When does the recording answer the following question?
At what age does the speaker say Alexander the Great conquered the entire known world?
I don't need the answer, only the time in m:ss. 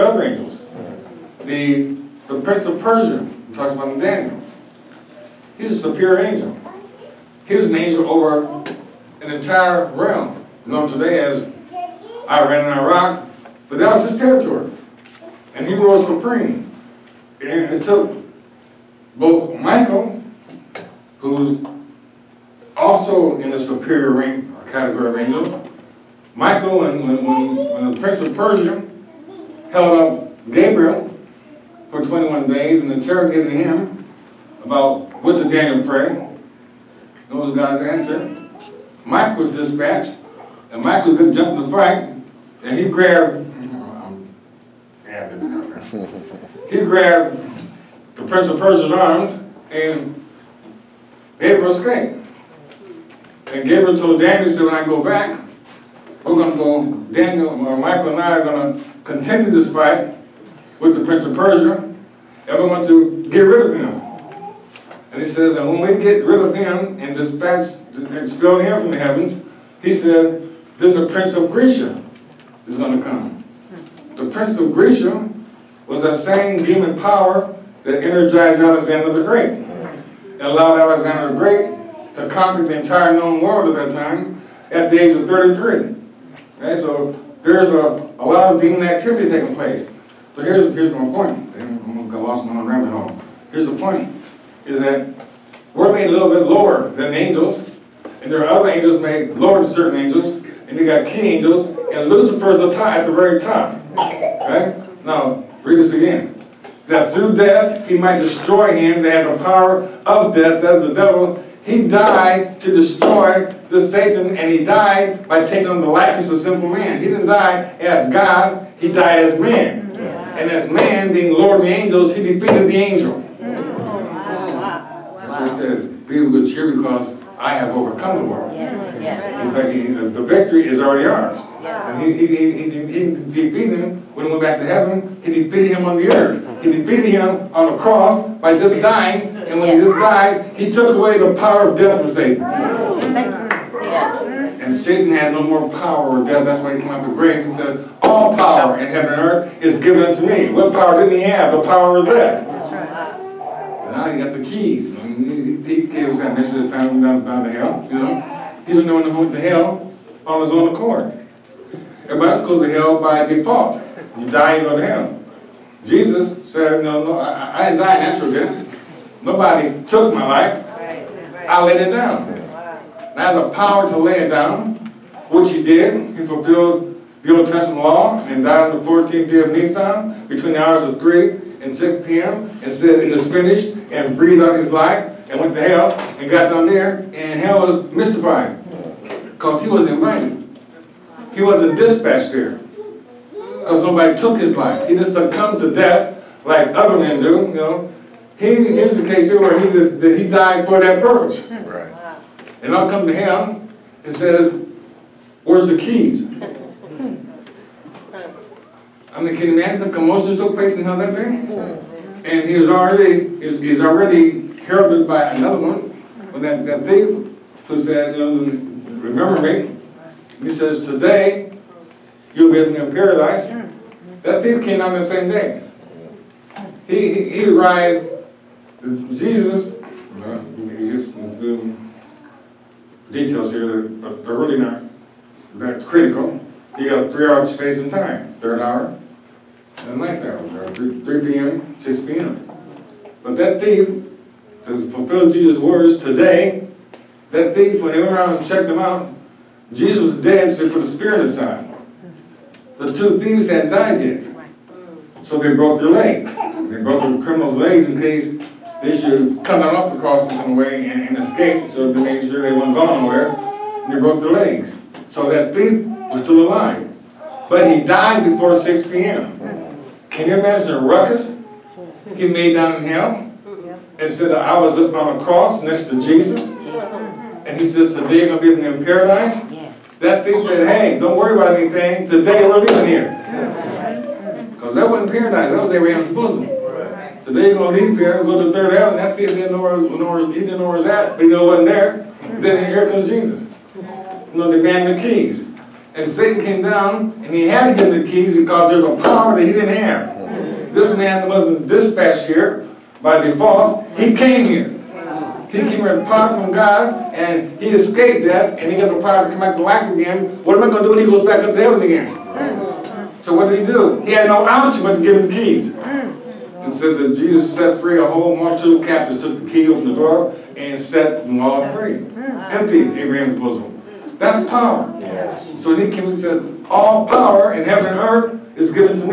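1:24.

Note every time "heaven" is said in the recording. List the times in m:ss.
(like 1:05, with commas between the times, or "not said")
1:08, 2:14, 2:28, 4:48, 5:11, 5:27.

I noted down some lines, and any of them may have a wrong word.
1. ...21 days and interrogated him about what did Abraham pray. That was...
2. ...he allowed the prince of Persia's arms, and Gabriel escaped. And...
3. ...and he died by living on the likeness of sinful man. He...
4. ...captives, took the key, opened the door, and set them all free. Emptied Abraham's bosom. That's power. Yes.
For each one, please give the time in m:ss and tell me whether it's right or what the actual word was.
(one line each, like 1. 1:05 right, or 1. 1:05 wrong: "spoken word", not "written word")
1. 0:32 wrong: "Daniel", not "Abraham"
2. 0:46 wrong: "grabbed", not "allowed"
3. 1:54 wrong: "taking", not "living"
4. 5:18 right.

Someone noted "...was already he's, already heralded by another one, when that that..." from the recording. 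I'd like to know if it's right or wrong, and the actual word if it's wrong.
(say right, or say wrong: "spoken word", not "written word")
right.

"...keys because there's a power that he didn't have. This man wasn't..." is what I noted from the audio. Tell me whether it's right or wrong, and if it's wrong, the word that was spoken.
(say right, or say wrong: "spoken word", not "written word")
right.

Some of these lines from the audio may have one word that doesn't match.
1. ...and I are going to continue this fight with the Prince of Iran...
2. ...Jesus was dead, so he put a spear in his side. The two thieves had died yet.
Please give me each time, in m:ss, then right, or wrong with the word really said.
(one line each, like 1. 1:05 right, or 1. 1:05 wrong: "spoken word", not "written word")
1. 0:58 wrong: "Persia", not "Iran"
2. 4:09 right.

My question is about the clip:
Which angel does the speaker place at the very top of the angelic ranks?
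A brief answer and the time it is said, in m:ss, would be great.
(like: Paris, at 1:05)
Lucifer, at 1:42.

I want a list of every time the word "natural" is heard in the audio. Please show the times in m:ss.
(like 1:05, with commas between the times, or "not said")
2:47.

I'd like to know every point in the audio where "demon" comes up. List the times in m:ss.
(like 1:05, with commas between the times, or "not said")
1:16, 1:28.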